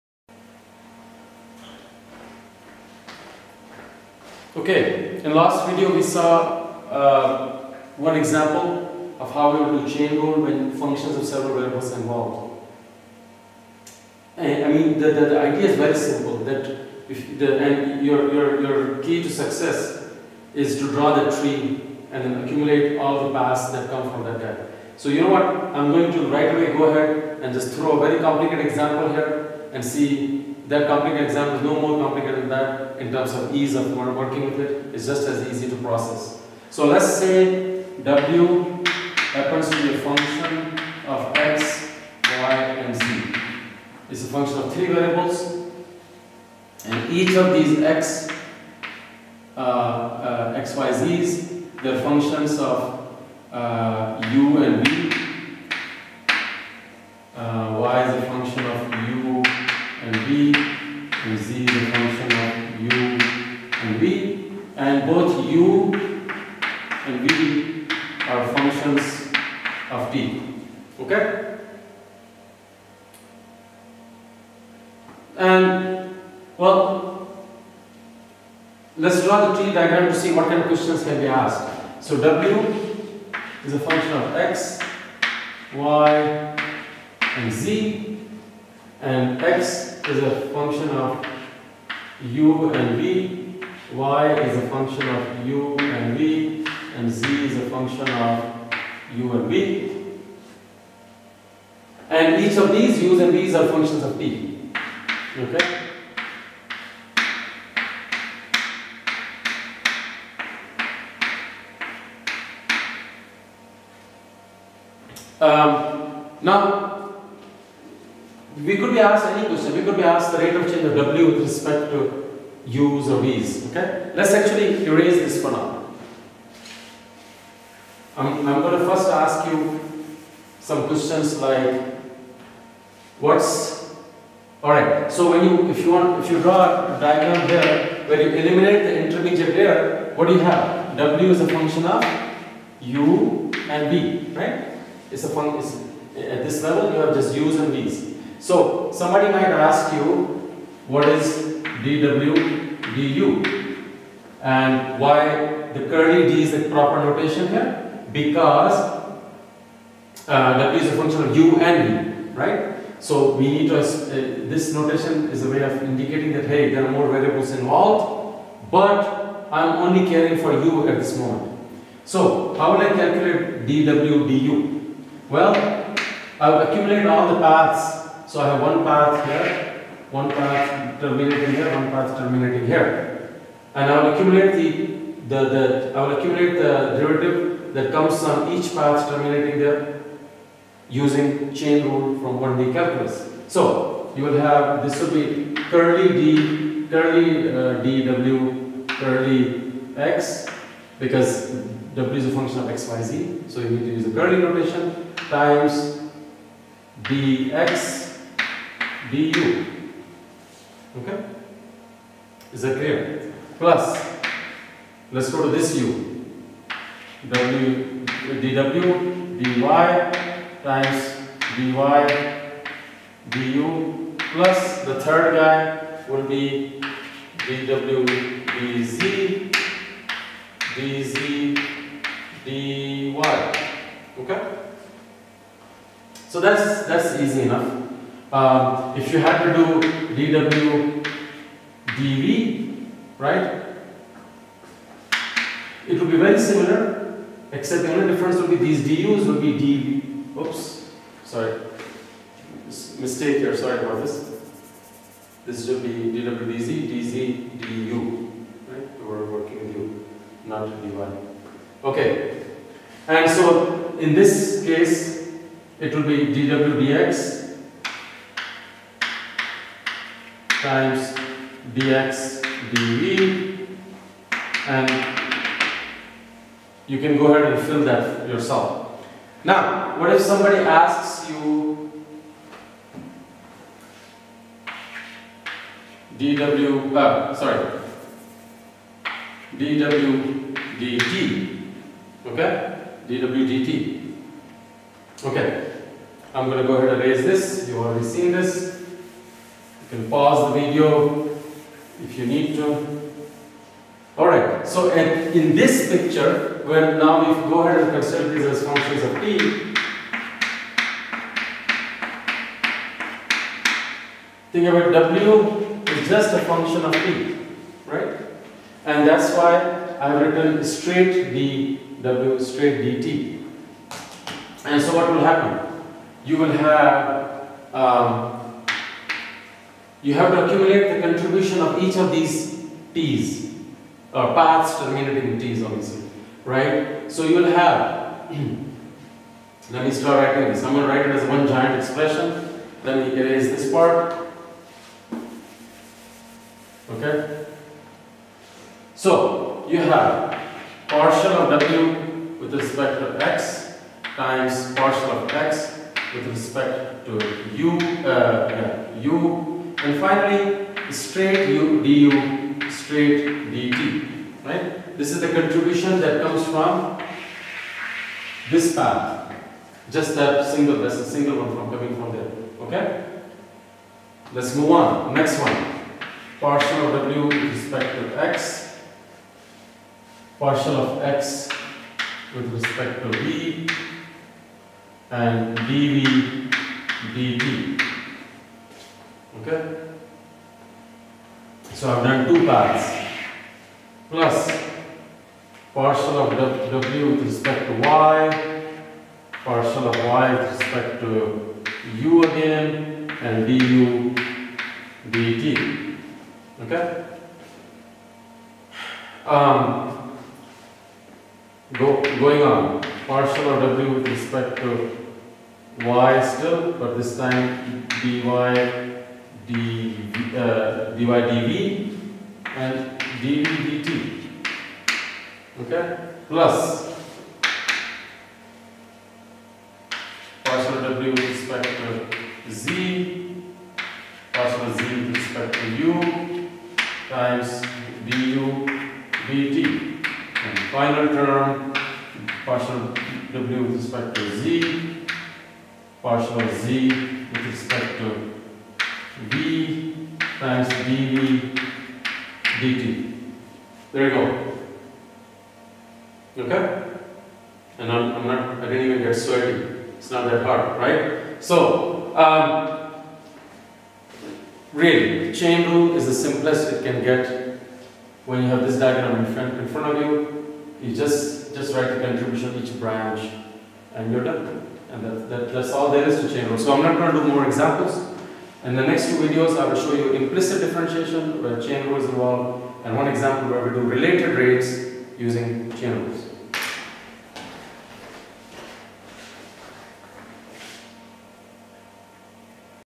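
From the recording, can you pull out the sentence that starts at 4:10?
Oops, sorry, mistake here, sorry about this.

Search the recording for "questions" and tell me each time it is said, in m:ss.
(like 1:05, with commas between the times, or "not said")
1:20, 1:59, 2:10.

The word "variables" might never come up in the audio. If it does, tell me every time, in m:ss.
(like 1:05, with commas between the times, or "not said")
0:11, 0:44, 2:47.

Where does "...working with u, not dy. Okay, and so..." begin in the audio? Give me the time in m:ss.
4:19.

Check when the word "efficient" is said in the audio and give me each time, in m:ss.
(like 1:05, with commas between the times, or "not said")
not said.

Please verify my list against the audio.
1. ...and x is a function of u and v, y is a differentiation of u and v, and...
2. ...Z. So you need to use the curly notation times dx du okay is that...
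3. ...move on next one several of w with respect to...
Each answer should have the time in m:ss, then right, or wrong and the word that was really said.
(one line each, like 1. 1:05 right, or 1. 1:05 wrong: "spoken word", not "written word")
1. 1:29 wrong: "function", not "differentiation"
2. 3:23 right
3. 6:14 wrong: "partial", not "several".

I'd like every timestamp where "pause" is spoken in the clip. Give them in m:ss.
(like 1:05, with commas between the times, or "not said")
5:00.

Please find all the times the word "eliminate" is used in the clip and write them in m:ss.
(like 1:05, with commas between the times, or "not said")
2:18.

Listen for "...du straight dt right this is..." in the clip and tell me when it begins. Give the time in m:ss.
6:01.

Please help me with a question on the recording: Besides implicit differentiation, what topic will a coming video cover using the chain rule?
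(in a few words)
Related rates.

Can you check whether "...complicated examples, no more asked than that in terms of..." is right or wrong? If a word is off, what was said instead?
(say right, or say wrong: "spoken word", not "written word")
wrong: "complicated", not "asked".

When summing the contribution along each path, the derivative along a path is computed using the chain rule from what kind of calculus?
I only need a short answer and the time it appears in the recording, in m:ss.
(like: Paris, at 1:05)
1D calculus, at 3:12.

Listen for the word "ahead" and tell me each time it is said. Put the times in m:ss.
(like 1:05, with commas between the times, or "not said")
0:26, 4:37, 4:56, 5:07.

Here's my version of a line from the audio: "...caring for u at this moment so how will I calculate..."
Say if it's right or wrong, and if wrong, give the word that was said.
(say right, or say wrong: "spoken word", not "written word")
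right.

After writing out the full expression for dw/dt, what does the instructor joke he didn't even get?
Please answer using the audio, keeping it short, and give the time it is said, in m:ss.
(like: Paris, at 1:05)
Sweaty, at 7:39.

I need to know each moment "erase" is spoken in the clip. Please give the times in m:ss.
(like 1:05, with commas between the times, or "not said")
2:04, 4:57, 5:43.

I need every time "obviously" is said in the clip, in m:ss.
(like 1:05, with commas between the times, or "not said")
5:35.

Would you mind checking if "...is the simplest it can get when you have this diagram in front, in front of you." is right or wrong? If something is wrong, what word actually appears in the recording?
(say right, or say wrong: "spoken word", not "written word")
right.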